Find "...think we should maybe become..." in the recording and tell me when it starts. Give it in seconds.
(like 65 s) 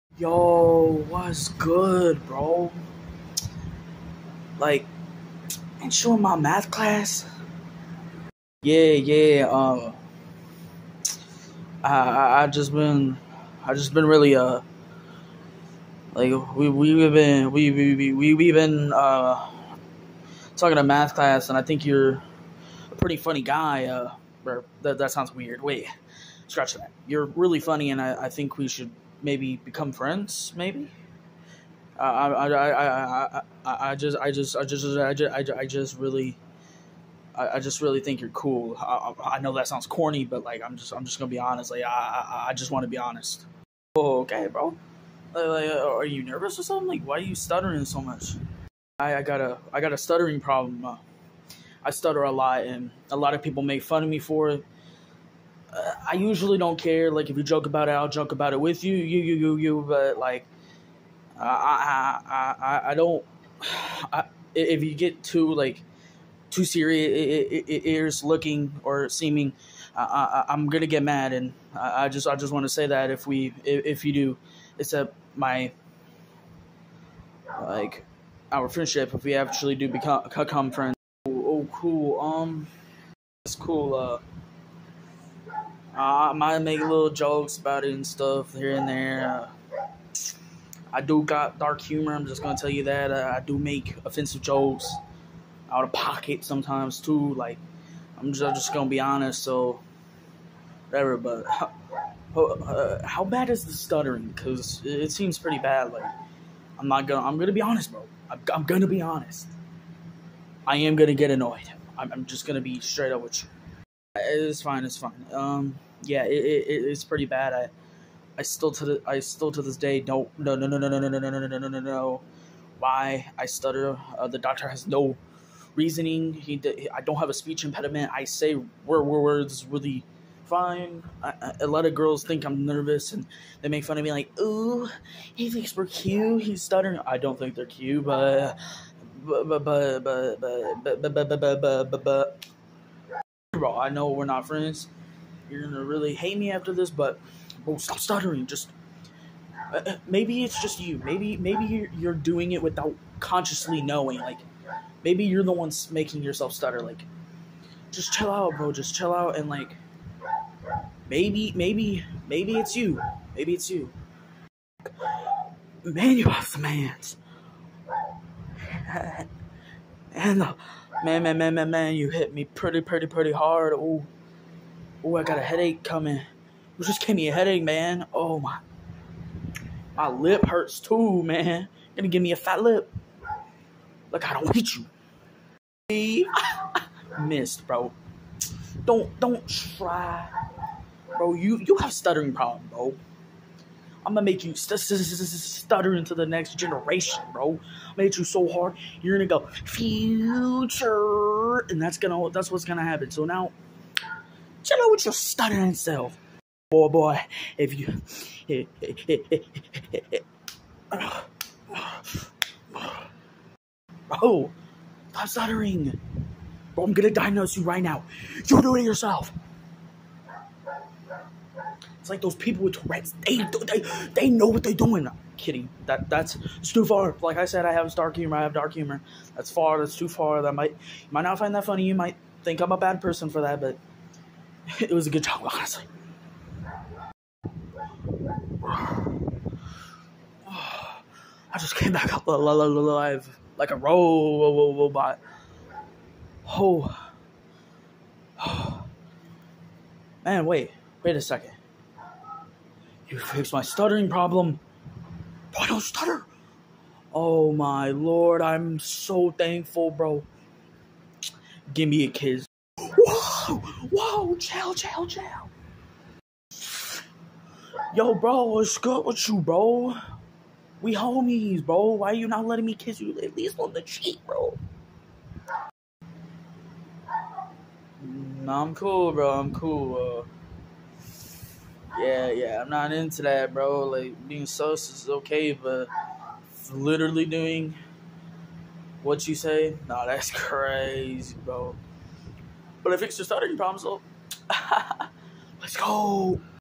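28 s.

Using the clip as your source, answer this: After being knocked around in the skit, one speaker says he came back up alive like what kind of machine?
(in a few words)
robot.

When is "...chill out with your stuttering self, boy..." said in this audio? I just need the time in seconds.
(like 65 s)
204 s.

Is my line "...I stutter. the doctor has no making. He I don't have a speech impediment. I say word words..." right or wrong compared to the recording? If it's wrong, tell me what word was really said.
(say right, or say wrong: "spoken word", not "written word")
wrong: "reasoning", not "making".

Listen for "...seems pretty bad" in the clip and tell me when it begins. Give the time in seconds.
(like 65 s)
105 s.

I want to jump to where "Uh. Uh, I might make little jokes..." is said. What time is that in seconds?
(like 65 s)
83 s.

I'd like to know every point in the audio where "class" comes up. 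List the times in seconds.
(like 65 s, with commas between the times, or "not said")
6 s, 21 s.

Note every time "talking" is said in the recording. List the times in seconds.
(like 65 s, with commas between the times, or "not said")
20 s.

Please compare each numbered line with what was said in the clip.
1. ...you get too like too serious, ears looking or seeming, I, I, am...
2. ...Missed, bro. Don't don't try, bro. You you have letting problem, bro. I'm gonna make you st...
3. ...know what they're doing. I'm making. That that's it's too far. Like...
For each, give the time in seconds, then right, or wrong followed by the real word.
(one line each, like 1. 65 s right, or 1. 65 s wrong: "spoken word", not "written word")
1. 64 s right
2. 187 s wrong: "stuttering", not "letting"
3. 224 s wrong: "kidding", not "making".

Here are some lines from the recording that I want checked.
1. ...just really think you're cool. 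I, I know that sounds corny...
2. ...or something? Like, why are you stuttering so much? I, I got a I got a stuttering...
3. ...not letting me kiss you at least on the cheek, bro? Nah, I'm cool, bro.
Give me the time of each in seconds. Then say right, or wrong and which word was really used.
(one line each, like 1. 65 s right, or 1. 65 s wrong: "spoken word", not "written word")
1. 37 s right
2. 46 s right
3. 272 s right.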